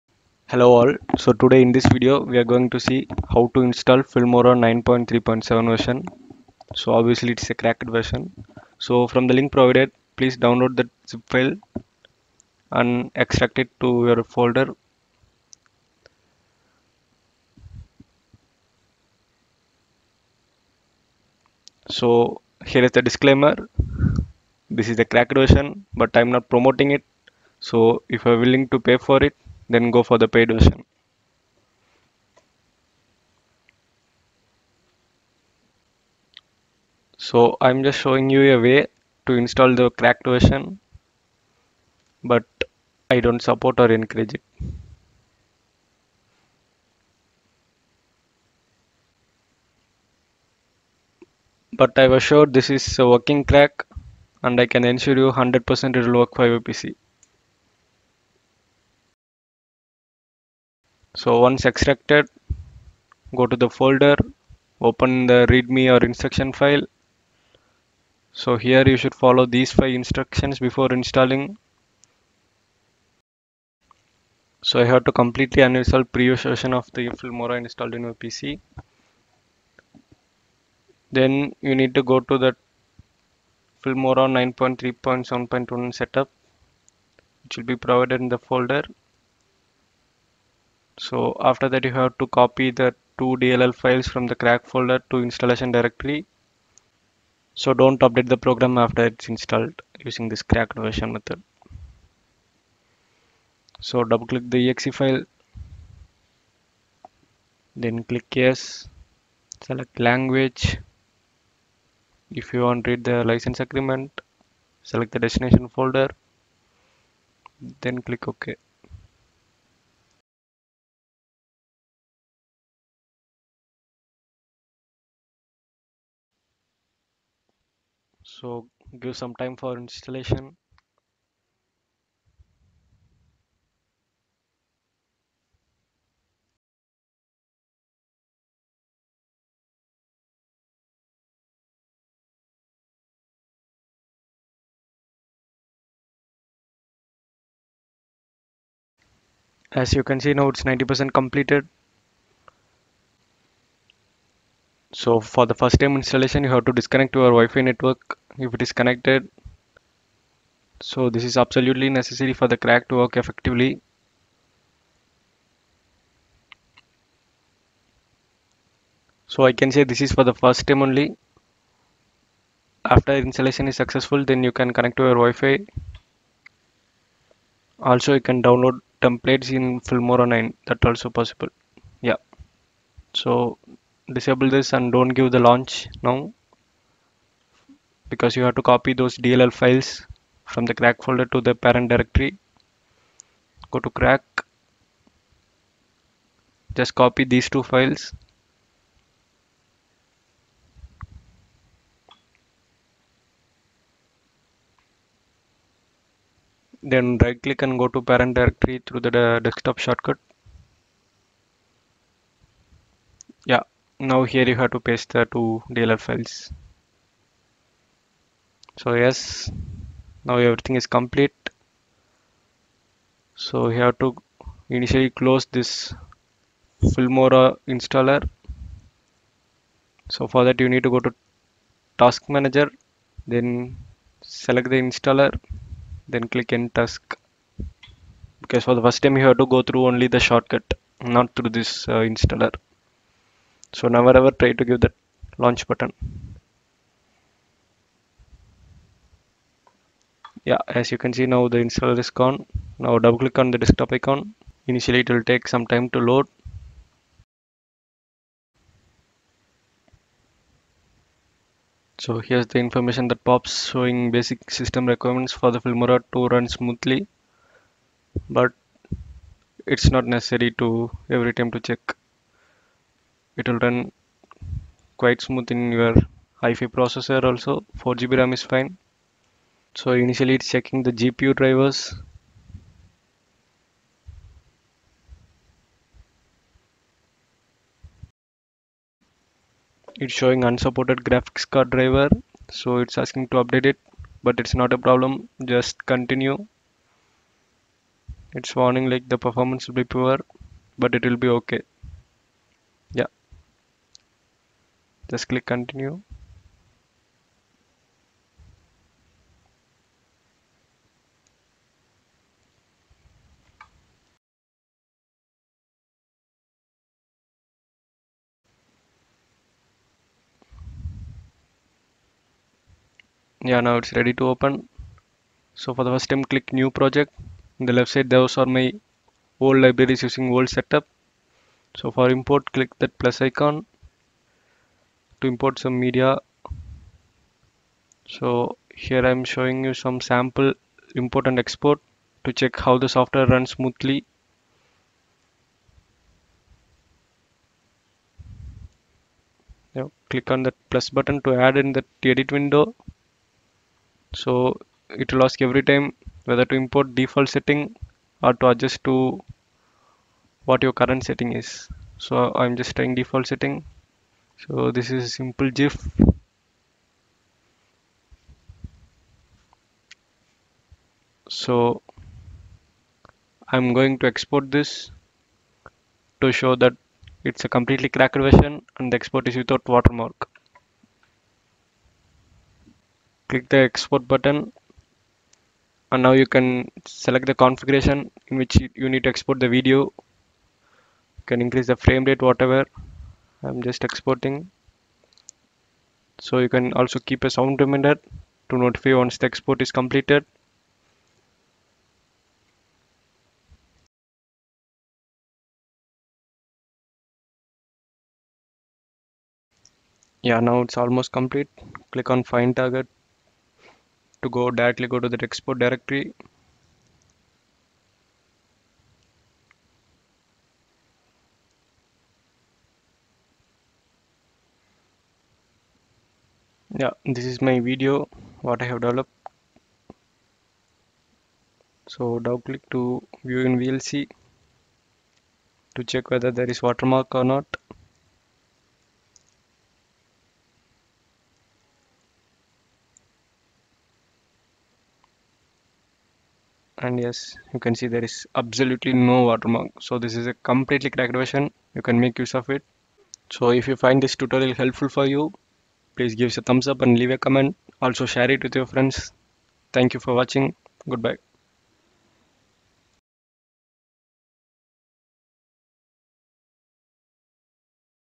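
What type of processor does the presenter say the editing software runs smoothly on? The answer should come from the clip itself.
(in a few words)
i5.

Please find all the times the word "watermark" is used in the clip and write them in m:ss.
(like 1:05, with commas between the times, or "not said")
6:19, 7:16, 7:29.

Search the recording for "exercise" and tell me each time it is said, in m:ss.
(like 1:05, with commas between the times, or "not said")
not said.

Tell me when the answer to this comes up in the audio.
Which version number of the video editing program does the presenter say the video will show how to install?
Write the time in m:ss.
0:04.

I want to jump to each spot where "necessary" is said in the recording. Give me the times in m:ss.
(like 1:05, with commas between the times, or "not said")
2:41, 4:30.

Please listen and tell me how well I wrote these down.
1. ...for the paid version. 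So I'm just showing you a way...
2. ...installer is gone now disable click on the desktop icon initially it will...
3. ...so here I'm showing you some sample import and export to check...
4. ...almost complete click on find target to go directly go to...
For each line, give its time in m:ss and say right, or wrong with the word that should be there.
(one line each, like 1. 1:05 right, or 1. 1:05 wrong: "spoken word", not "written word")
1. 0:30 right
2. 4:11 wrong: "double", not "disable"
3. 5:38 right
4. 6:50 right.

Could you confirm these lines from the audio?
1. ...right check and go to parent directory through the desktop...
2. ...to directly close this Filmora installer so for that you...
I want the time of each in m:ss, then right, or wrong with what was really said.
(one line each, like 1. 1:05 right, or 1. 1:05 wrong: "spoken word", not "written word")
1. 3:27 wrong: "click", not "check"
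2. 3:44 wrong: "initially", not "directly".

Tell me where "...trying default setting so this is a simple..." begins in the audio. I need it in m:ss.
6:02.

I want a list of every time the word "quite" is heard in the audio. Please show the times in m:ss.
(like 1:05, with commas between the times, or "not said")
4:34.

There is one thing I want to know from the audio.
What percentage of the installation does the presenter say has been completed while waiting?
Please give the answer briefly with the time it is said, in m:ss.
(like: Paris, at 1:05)
90%, at 2:30.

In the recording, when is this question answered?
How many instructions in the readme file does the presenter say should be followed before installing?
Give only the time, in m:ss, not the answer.
1:09.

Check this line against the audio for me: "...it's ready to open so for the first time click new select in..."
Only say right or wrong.
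wrong.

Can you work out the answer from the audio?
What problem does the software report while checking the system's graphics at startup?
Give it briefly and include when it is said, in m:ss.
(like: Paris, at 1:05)
Unsupported graphics card driver, at 4:50.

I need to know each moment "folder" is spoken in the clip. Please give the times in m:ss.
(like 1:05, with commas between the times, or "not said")
0:14, 1:03, 1:28, 1:34, 1:55, 3:11.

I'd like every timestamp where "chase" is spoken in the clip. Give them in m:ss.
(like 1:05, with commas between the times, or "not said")
not said.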